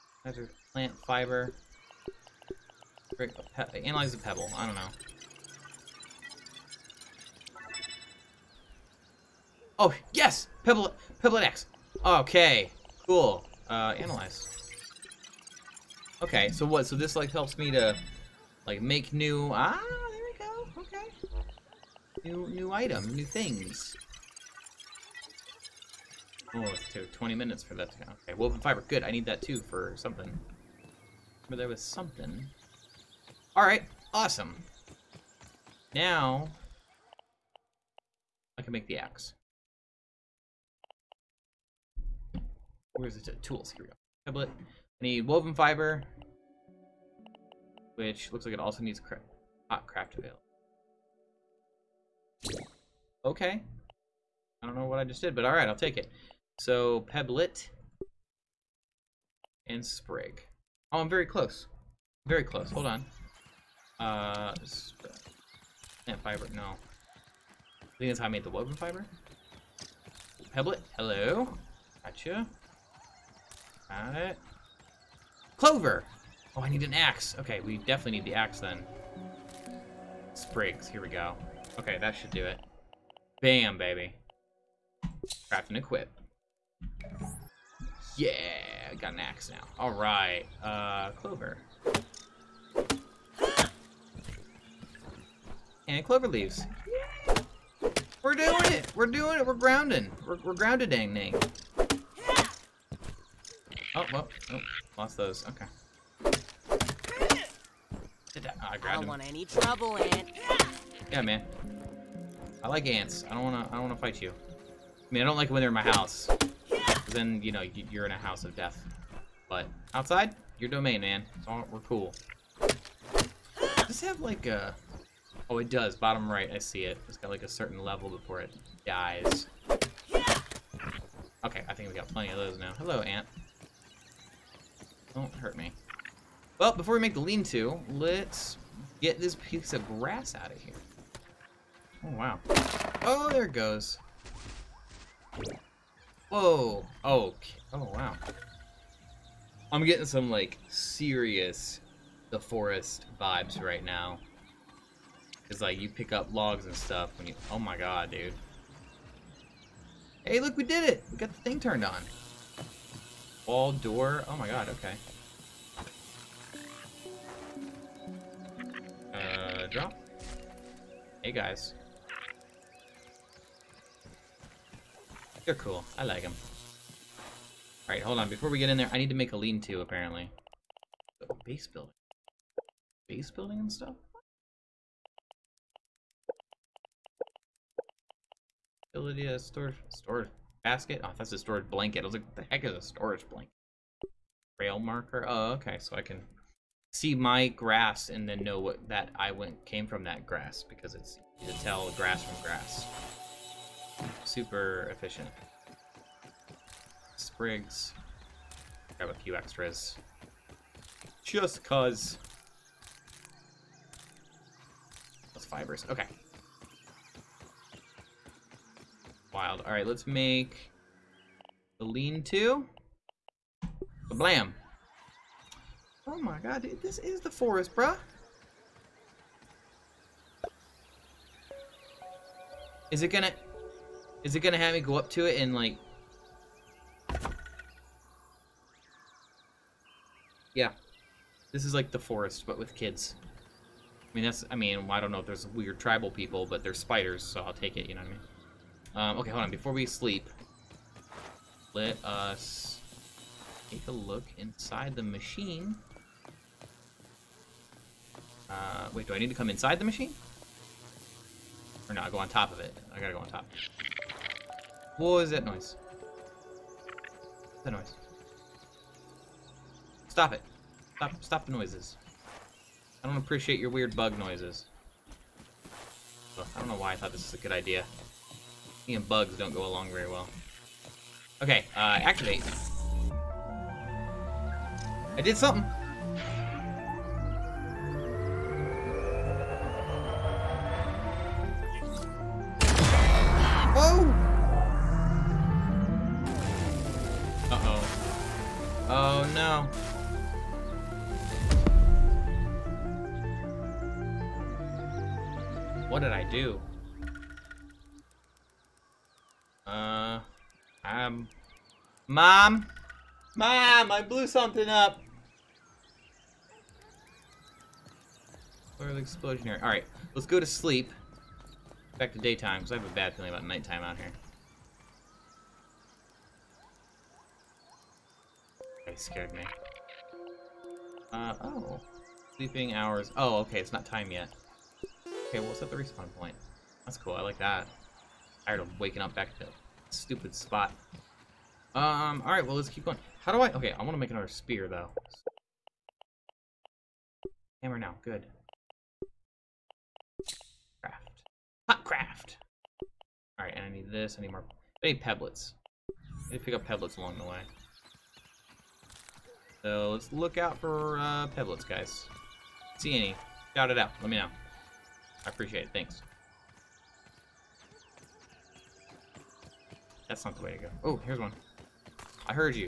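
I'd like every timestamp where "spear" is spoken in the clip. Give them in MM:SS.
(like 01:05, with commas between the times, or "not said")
05:44.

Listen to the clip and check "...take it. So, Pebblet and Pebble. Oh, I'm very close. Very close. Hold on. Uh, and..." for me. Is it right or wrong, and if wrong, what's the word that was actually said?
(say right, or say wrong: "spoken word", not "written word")
wrong: "Sprig", not "Pebble".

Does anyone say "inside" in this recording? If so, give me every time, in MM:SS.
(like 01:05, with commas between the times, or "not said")
04:14, 04:19.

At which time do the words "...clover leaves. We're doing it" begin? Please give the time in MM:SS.
01:36.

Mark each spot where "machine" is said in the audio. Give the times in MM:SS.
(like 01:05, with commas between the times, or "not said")
04:15, 04:19.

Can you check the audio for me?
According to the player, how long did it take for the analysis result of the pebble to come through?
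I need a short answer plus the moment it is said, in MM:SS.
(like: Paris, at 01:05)
20 minutes, at 00:27.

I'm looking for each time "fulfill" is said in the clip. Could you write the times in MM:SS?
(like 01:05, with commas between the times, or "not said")
not said.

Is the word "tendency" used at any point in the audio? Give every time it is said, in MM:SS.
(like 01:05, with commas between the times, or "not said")
not said.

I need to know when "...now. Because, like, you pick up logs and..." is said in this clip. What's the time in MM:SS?
02:33.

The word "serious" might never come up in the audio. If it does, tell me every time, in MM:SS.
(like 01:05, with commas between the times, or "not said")
02:30.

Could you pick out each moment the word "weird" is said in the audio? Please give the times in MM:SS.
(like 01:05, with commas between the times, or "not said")
04:05, 04:33.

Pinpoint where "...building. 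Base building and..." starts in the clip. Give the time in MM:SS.
03:01.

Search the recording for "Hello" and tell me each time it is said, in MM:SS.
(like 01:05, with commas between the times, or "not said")
01:10, 02:12.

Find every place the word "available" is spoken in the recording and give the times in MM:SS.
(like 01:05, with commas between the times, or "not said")
00:50.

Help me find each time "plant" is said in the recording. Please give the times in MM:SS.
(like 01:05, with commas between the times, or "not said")
00:00.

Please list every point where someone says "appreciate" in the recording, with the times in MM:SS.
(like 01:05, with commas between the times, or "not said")
04:33, 06:05.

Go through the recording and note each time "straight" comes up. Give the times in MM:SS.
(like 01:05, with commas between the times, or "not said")
not said.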